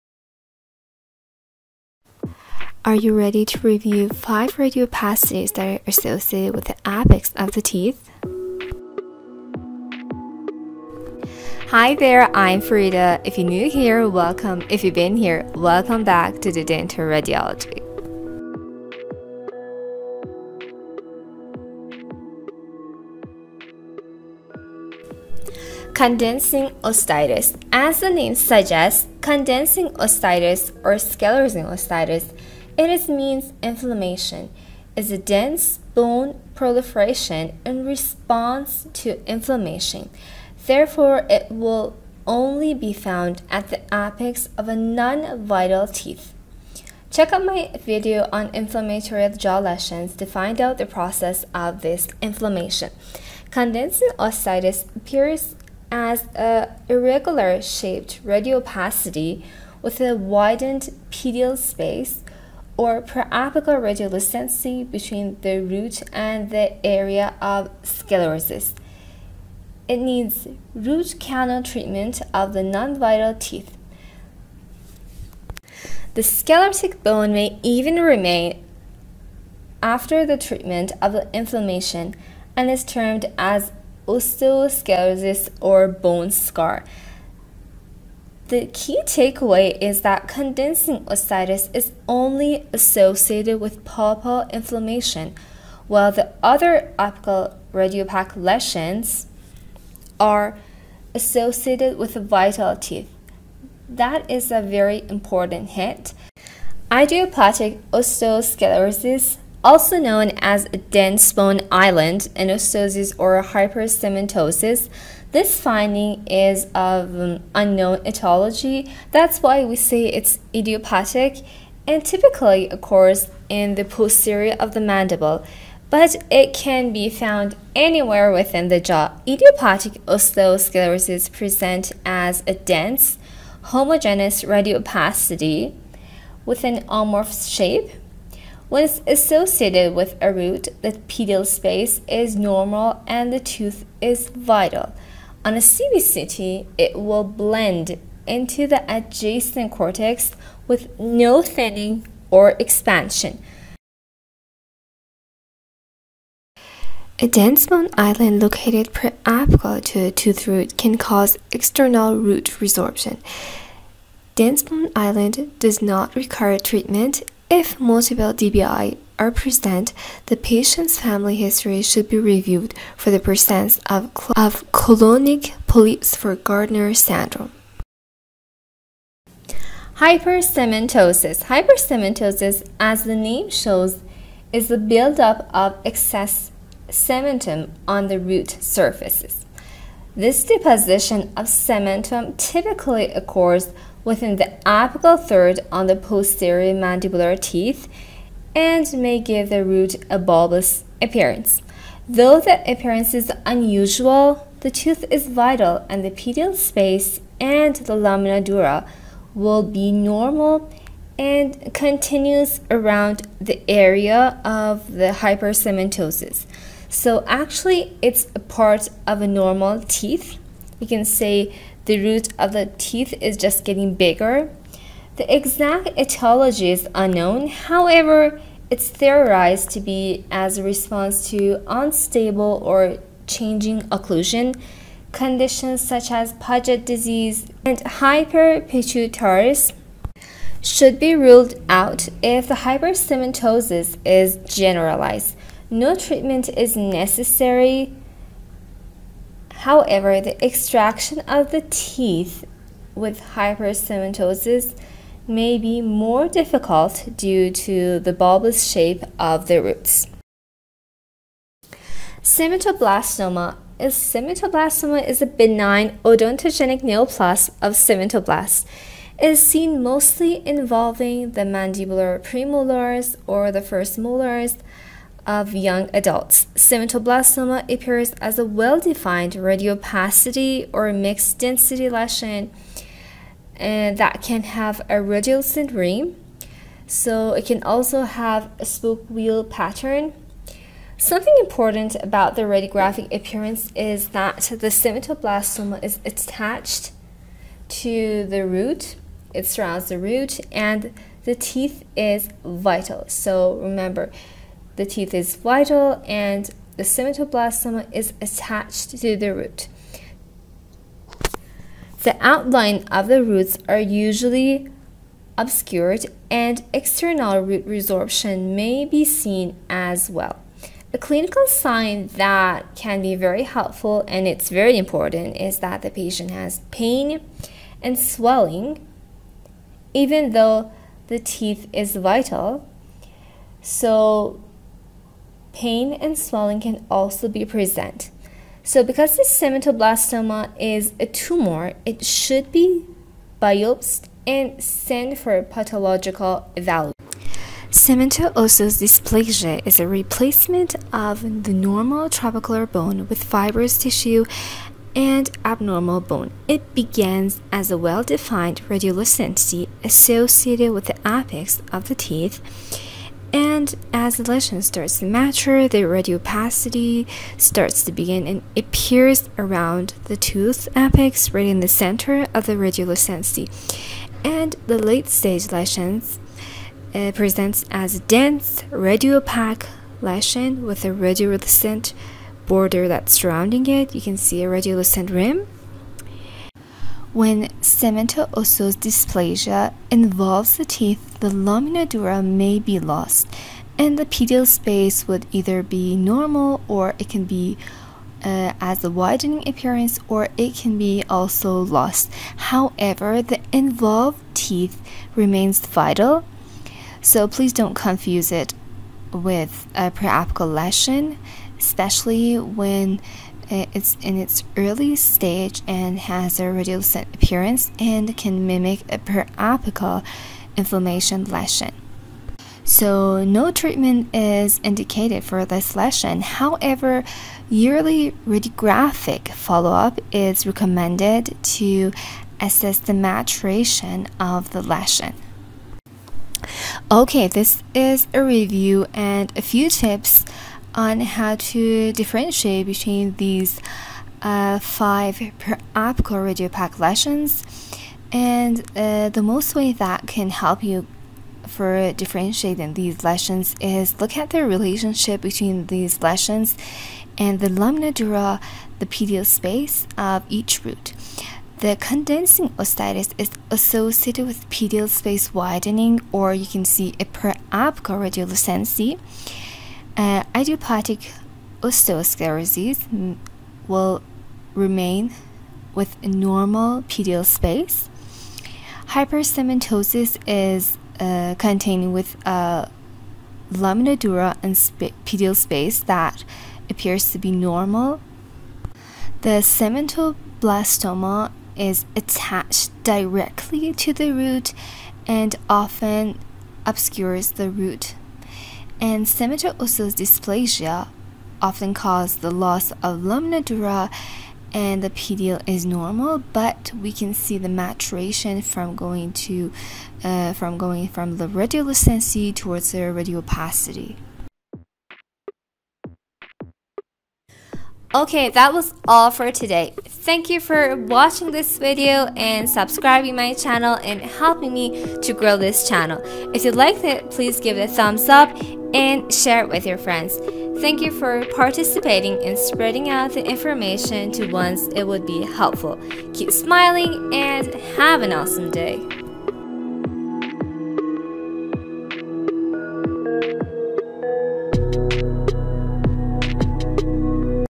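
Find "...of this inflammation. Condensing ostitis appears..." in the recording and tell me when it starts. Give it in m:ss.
0:51.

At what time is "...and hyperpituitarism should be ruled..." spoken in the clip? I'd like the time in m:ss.
3:57.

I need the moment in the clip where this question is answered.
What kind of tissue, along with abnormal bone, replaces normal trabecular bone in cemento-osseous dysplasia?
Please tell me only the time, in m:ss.
5:53.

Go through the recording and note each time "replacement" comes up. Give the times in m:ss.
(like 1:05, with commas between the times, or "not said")
5:49.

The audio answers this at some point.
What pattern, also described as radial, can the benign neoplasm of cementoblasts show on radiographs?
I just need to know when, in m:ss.
4:48.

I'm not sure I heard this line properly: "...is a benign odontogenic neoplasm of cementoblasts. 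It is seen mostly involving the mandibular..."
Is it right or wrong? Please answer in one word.
right.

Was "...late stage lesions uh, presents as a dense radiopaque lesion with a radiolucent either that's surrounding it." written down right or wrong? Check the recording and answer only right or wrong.
wrong.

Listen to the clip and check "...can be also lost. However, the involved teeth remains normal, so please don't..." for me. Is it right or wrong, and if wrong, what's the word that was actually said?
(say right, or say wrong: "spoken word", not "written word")
wrong: "vital", not "normal".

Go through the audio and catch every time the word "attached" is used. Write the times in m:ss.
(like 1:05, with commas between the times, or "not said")
4:56, 5:08, 8:11.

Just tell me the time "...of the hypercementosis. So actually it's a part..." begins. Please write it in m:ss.
3:34.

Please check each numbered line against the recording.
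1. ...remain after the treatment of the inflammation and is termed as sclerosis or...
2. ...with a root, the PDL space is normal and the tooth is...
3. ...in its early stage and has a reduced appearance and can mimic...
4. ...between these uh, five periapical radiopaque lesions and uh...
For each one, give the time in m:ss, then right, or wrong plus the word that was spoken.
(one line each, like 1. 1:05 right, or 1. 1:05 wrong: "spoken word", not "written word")
1. 1:18 wrong: "osteosclerosis", not "sclerosis"
2. 2:19 right
3. 6:54 right
4. 7:22 right.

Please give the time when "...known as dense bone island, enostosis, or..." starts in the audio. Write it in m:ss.
1:49.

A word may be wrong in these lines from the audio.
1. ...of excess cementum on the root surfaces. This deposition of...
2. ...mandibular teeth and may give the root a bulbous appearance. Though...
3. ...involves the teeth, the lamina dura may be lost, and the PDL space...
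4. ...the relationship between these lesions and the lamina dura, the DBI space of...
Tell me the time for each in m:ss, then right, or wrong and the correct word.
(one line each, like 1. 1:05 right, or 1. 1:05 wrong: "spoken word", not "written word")
1. 3:05 right
2. 3:16 right
3. 6:29 right
4. 7:34 wrong: "PDL", not "DBI".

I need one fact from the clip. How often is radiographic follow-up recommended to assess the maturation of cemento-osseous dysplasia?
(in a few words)
Yearly.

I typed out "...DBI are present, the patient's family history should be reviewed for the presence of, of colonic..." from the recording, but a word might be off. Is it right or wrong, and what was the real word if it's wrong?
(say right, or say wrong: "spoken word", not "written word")
right.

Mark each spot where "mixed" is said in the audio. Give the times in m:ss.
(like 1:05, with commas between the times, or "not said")
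4:40.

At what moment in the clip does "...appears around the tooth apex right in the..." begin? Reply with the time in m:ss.
6:08.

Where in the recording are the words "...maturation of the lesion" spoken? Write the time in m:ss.
7:12.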